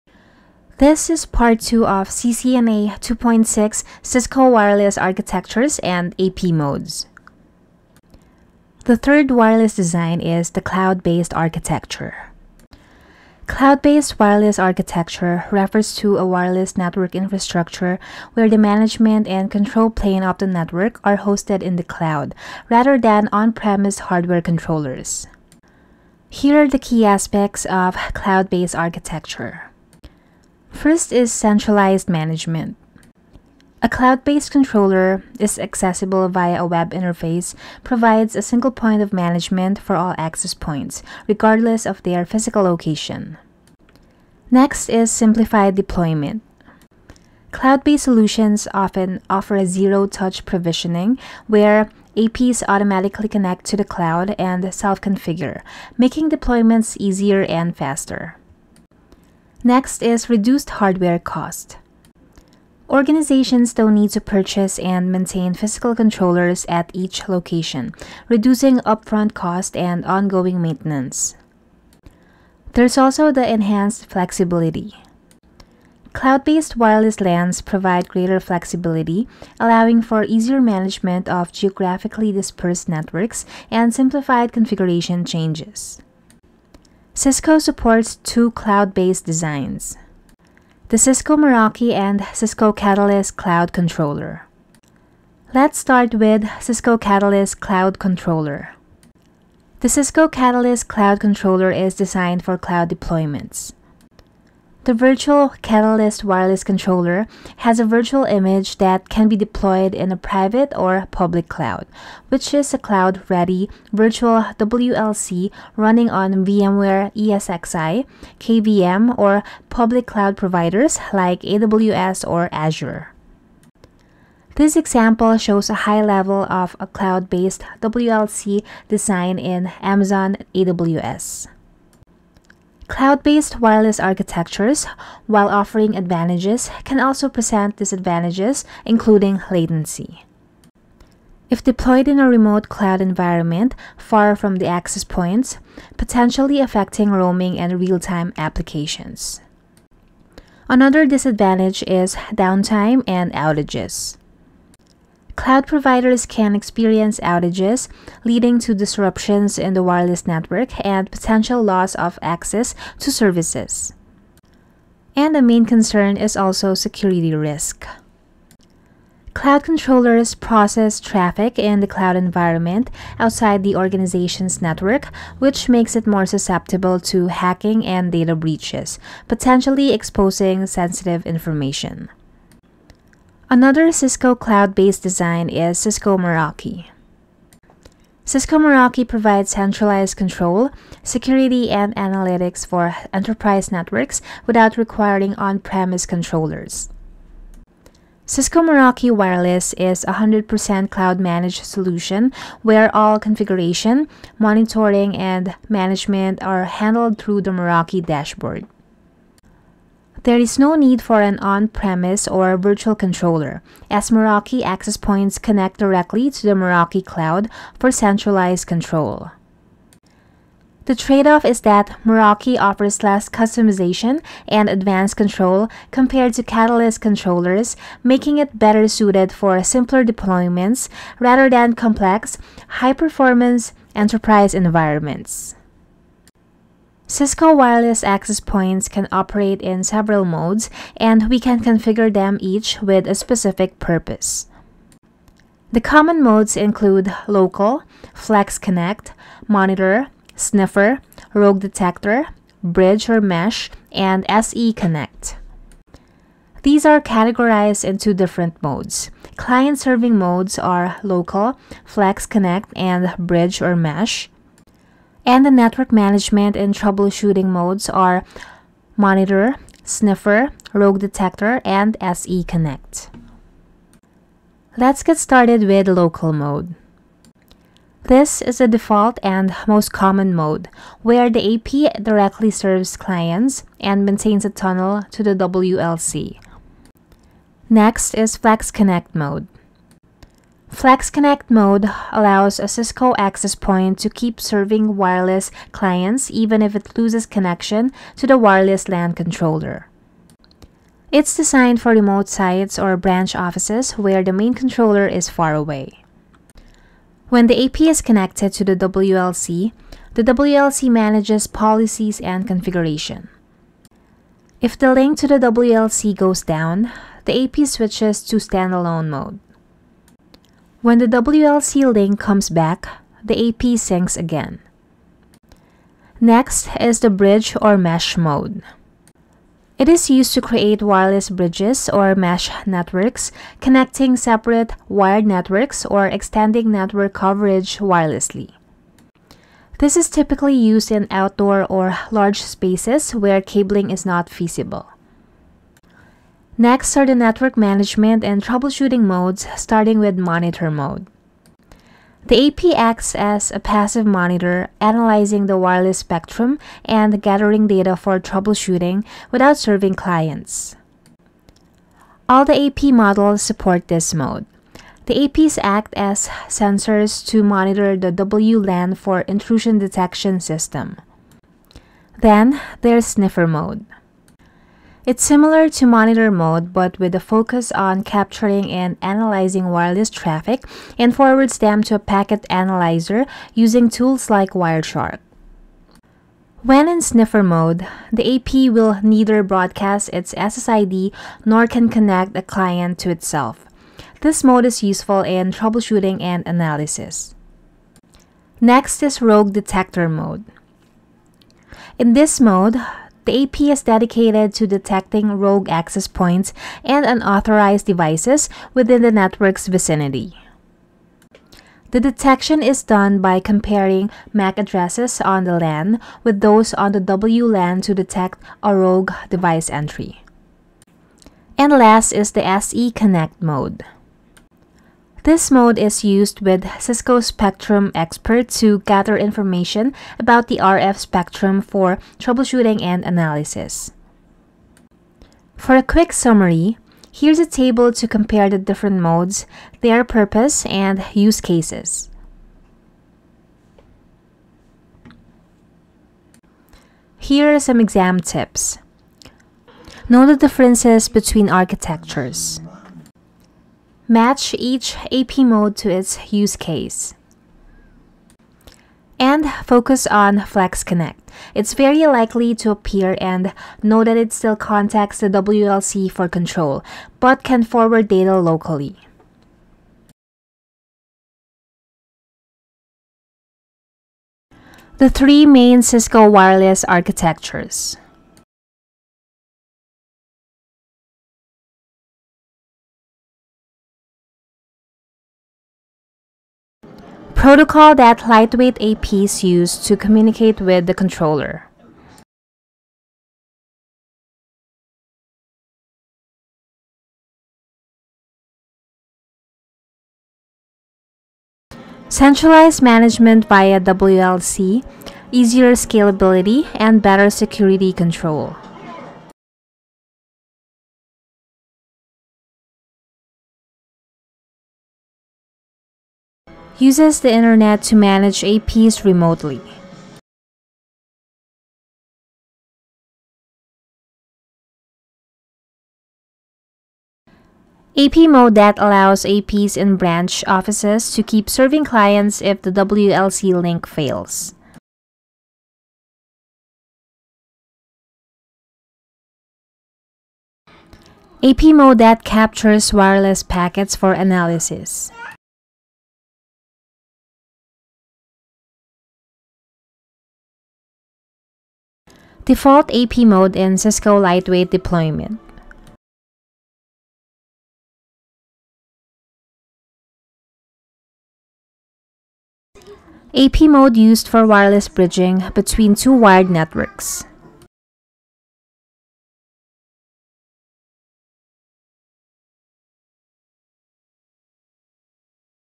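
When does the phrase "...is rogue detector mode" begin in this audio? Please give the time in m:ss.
6:39.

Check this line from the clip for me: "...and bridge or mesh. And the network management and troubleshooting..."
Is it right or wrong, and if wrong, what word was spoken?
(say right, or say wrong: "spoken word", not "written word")
right.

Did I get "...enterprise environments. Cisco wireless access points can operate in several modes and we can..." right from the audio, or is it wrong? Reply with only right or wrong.
right.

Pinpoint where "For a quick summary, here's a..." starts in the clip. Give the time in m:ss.
7:15.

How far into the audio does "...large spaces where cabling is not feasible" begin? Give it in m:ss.
5:42.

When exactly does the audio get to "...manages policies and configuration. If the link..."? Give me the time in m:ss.
5:10.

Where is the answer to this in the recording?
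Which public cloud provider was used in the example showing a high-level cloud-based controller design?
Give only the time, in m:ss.
2:09.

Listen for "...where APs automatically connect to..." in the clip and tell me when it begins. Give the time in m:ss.
0:51.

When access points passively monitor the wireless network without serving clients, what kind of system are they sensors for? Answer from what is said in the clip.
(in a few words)
intrusion detection system.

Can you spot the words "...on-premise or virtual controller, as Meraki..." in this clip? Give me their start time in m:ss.
3:31.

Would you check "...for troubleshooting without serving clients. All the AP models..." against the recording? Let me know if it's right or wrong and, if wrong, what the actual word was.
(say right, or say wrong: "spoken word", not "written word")
right.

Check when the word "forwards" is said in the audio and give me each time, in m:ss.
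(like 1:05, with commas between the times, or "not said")
6:21, 7:47.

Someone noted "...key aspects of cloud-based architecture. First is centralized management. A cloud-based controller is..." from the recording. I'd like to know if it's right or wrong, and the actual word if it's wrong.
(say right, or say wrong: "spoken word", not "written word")
right.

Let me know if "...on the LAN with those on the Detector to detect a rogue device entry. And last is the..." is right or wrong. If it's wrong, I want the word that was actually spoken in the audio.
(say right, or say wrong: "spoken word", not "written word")
wrong: "WLAN", not "Detector".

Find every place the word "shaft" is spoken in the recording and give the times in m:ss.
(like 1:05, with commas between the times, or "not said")
not said.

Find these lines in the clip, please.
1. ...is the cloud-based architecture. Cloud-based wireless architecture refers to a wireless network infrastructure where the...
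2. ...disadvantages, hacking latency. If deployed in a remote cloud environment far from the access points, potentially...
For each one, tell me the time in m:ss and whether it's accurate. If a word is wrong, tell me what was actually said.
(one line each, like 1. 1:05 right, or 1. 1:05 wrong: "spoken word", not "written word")
1. 0:10 right
2. 2:17 wrong: "including", not "hacking".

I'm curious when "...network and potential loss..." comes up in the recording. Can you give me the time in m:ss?
2:40.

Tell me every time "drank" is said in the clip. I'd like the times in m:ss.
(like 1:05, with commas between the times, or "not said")
not said.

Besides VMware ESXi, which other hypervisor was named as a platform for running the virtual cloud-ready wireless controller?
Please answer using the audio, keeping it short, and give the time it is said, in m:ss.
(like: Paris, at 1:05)
KVM, at 1:58.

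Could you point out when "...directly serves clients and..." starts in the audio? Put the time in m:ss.
4:42.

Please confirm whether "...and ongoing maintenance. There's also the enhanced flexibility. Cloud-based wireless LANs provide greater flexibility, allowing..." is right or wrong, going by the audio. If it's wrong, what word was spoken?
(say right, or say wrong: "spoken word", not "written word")
right.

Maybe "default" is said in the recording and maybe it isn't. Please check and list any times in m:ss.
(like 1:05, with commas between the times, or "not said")
4:38, 9:12.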